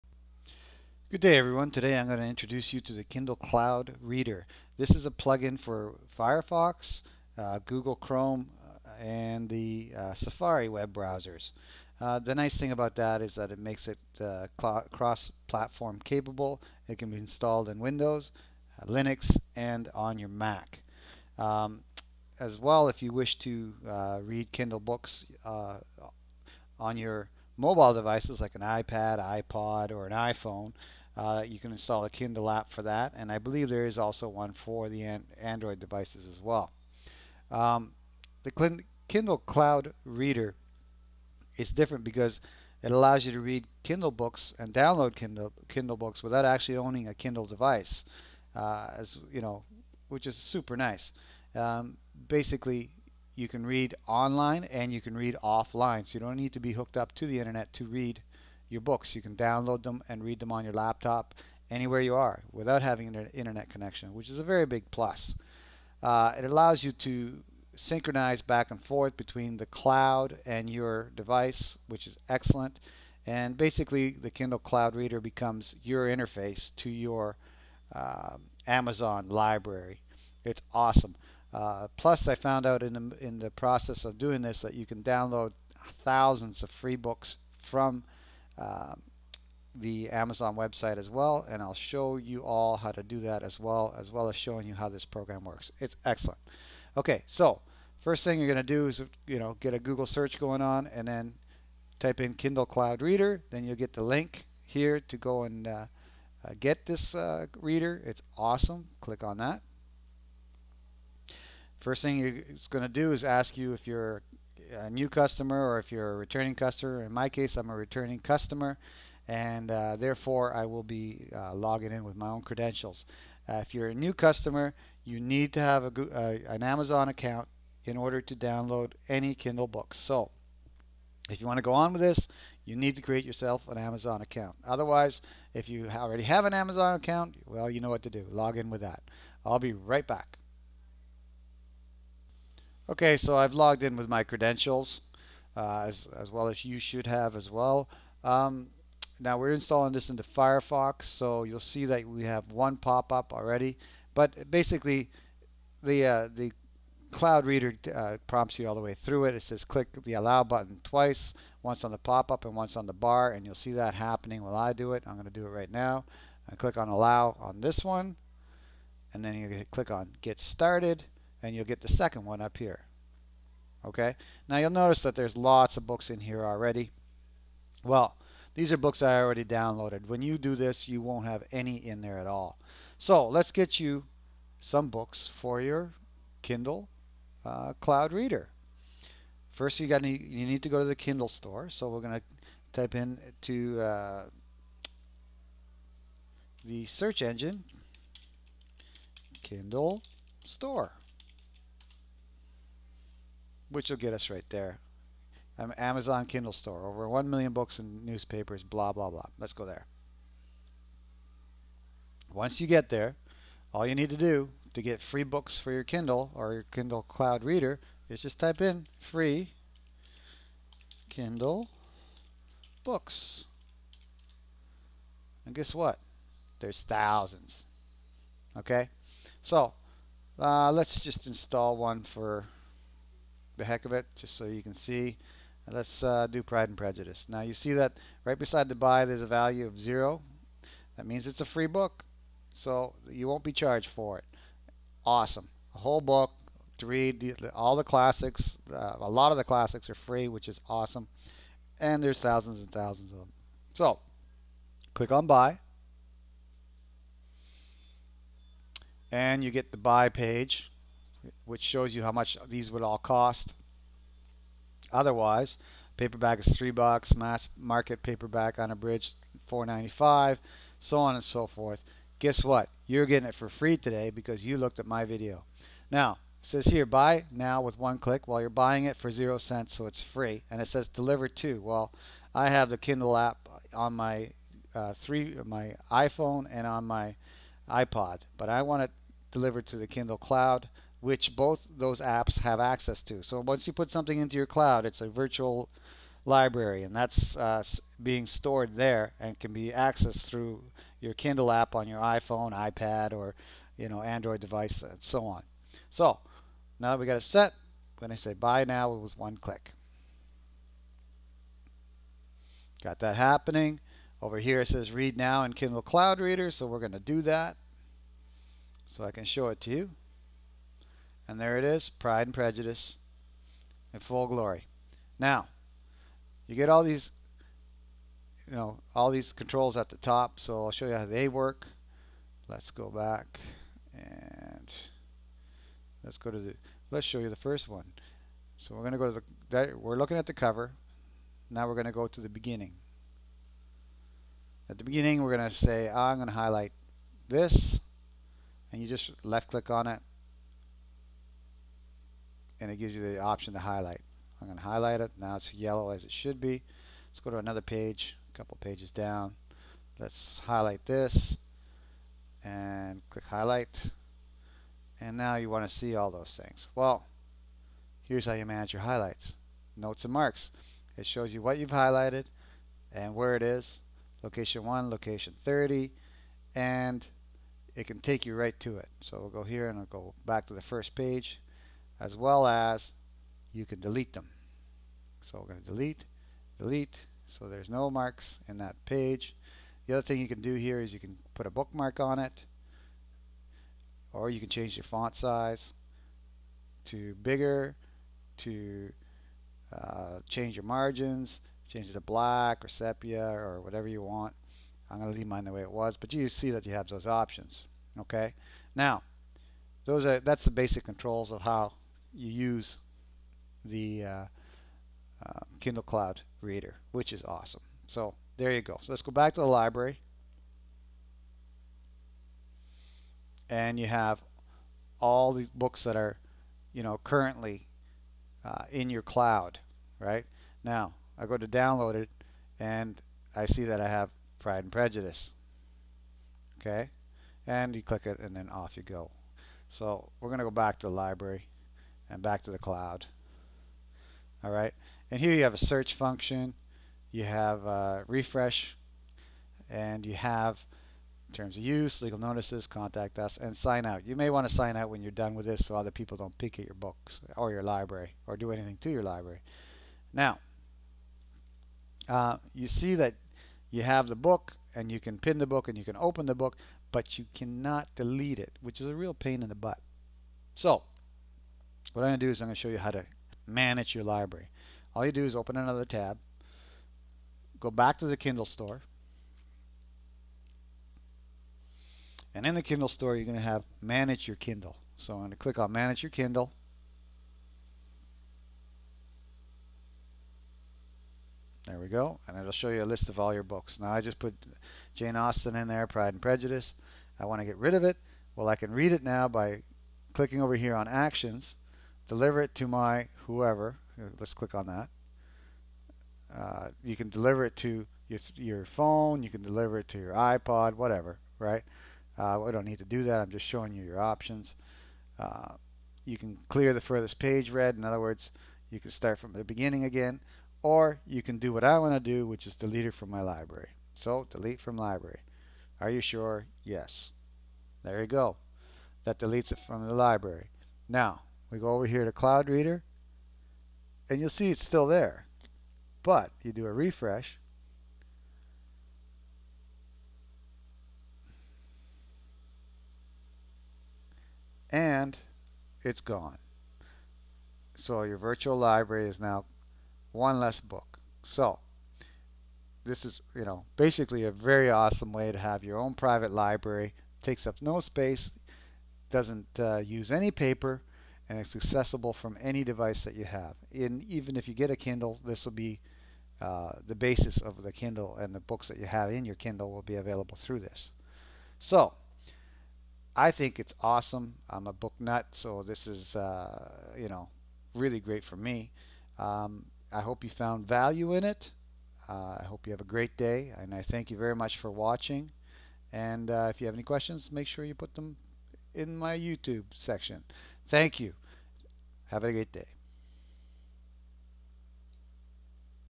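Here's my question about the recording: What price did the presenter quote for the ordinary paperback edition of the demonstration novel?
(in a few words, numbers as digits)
3 dollars.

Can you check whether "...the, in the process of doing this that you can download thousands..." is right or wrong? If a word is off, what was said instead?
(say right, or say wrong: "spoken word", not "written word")
right.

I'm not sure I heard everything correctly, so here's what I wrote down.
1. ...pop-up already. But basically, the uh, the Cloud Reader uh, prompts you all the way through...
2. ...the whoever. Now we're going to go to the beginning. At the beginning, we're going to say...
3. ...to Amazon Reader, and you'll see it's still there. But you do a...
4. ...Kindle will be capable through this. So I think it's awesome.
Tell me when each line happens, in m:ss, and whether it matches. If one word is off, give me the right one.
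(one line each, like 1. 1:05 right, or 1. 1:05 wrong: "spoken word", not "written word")
1. 2:32 right
2. 5:40 wrong: "cover", not "whoever"
3. 8:52 wrong: "Cloud", not "Amazon"
4. 9:29 wrong: "available", not "capable".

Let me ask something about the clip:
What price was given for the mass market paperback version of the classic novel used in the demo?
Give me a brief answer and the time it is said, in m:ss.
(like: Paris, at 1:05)
4.95, at 4:29.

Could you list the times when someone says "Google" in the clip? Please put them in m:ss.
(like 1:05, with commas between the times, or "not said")
0:07, 1:39.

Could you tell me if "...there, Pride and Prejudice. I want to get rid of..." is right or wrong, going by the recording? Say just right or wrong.
right.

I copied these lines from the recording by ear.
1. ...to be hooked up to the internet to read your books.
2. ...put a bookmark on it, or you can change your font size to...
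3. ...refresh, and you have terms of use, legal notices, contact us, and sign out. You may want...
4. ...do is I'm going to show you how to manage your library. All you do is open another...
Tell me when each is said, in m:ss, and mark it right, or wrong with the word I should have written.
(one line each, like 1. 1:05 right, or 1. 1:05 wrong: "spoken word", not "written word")
1. 0:56 right
2. 6:31 right
3. 7:28 right
4. 7:52 right.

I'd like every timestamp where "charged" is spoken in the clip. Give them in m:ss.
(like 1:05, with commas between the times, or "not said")
4:03.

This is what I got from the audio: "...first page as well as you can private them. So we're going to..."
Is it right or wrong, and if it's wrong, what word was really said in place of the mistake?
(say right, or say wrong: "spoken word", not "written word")
wrong: "delete", not "private".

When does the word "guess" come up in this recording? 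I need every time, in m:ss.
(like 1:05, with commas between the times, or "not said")
3:45, 4:32.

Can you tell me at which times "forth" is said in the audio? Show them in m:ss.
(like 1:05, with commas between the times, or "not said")
1:08, 4:31.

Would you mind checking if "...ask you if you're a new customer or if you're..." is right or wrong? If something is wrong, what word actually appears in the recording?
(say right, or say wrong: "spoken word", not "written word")
right.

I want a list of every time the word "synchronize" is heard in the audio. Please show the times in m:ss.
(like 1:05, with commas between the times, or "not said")
1:07.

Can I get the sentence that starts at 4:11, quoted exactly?
And there's thousands and thousands of them.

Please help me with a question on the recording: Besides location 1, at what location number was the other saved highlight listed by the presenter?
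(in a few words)
30.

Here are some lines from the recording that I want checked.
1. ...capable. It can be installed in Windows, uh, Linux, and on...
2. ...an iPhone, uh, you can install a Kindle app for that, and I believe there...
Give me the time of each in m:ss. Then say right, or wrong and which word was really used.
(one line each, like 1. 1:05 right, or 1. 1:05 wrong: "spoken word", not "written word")
1. 0:16 right
2. 0:30 right.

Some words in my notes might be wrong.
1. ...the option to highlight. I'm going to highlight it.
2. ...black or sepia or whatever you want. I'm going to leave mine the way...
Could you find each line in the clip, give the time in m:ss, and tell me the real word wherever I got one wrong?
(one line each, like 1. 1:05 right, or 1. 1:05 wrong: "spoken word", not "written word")
1. 5:53 right
2. 6:42 right.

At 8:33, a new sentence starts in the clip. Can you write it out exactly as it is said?
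I'm just showing you your options.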